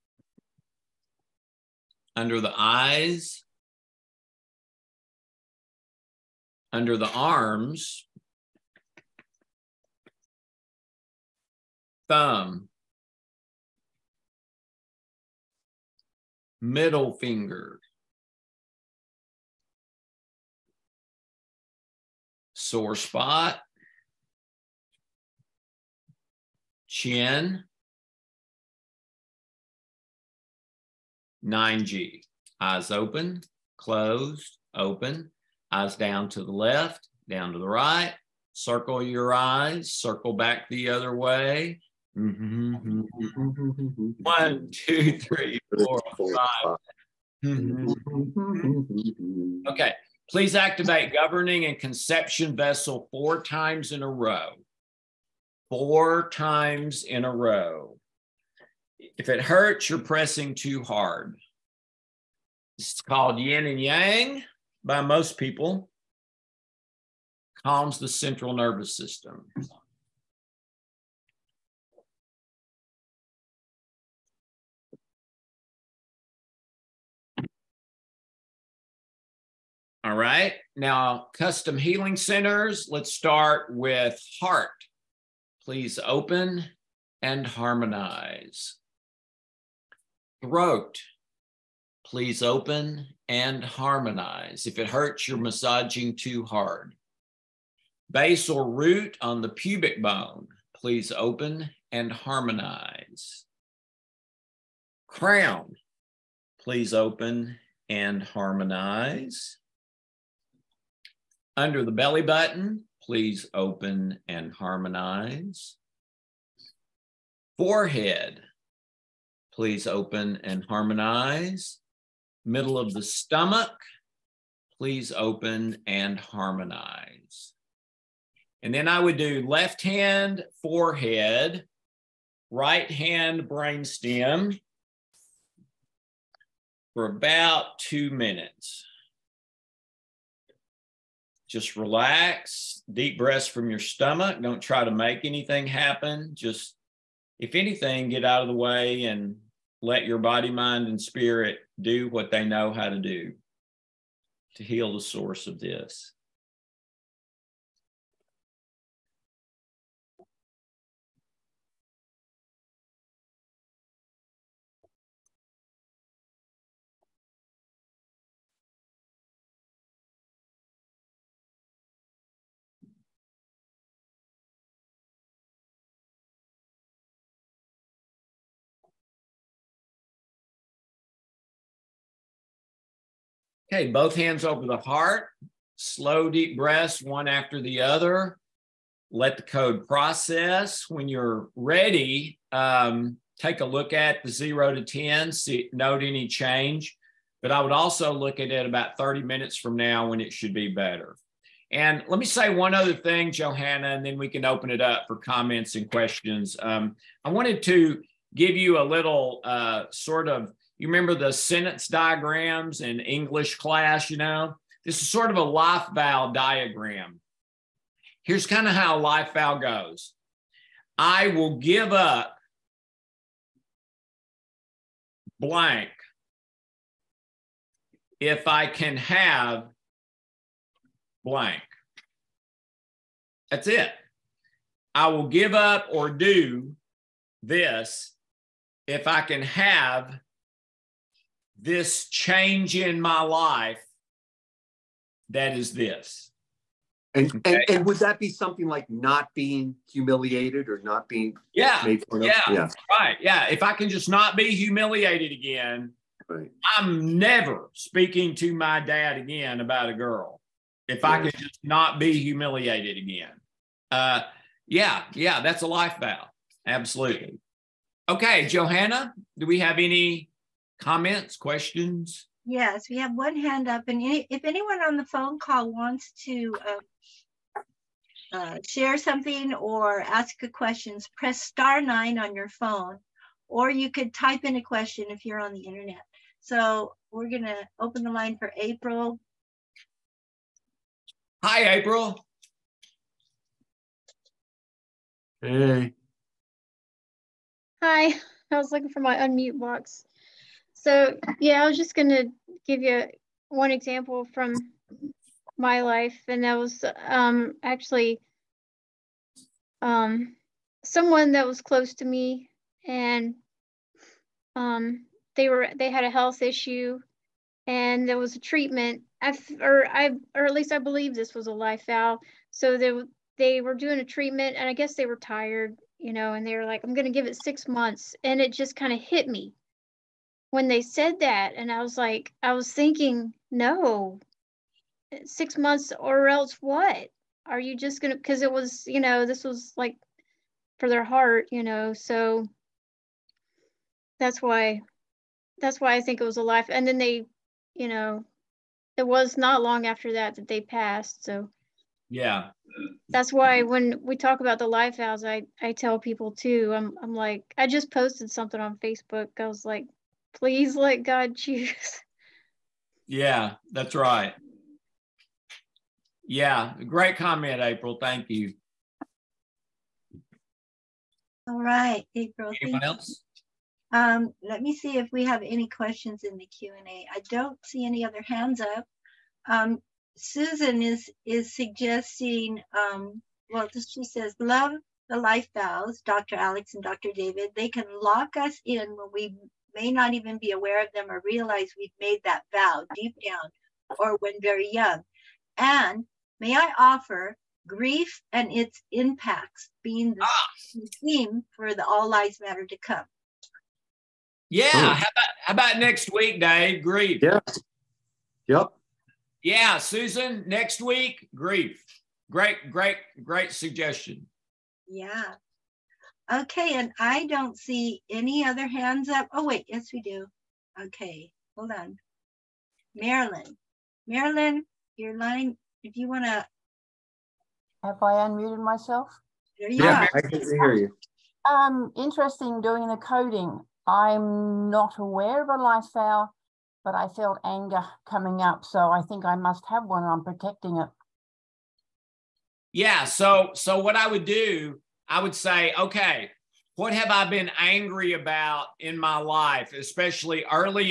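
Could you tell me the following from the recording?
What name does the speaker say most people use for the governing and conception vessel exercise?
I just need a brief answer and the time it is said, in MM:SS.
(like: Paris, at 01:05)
Yin and yang, at 01:03.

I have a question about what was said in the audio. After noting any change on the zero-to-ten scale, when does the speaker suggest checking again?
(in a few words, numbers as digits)
30 minutes.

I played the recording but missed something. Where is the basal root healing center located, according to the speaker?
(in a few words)
The pubic bone.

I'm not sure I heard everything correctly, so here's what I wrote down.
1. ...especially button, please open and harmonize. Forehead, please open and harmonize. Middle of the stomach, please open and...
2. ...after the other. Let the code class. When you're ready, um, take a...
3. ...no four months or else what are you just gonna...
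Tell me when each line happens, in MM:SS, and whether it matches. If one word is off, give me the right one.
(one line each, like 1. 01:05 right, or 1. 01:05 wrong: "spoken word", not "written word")
1. 01:51 wrong: "belly", not "especially"
2. 03:07 wrong: "process", not "class"
3. 05:33 wrong: "six", not "four".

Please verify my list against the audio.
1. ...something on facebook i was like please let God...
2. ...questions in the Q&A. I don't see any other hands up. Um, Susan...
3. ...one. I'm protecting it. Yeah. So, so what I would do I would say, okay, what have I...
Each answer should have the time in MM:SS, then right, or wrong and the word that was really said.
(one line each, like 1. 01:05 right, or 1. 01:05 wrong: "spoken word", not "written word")
1. 05:58 right
2. 06:15 right
3. 07:19 right.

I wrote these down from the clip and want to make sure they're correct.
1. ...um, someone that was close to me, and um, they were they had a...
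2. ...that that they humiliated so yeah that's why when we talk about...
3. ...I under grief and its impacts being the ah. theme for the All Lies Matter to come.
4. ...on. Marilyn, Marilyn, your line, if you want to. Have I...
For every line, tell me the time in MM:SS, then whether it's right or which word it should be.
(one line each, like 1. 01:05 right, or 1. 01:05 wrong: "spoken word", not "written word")
1. 05:09 right
2. 05:50 wrong: "passed", not "humiliated"
3. 06:36 wrong: "offer", not "under"
4. 07:01 right.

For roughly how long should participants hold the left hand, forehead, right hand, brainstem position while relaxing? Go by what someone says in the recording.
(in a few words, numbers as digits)
2 minutes.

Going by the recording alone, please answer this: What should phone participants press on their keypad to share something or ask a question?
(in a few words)
Star nine.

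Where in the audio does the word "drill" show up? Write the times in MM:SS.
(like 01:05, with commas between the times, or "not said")
not said.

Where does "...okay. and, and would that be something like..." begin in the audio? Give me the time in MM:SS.
04:07.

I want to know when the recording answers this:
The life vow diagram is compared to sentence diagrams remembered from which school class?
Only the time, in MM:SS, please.
03:32.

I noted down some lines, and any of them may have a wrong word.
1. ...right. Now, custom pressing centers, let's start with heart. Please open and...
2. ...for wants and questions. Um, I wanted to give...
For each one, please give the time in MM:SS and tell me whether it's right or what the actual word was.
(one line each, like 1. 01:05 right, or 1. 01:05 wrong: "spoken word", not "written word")
1. 01:20 wrong: "healing", not "pressing"
2. 03:25 wrong: "comments", not "wants".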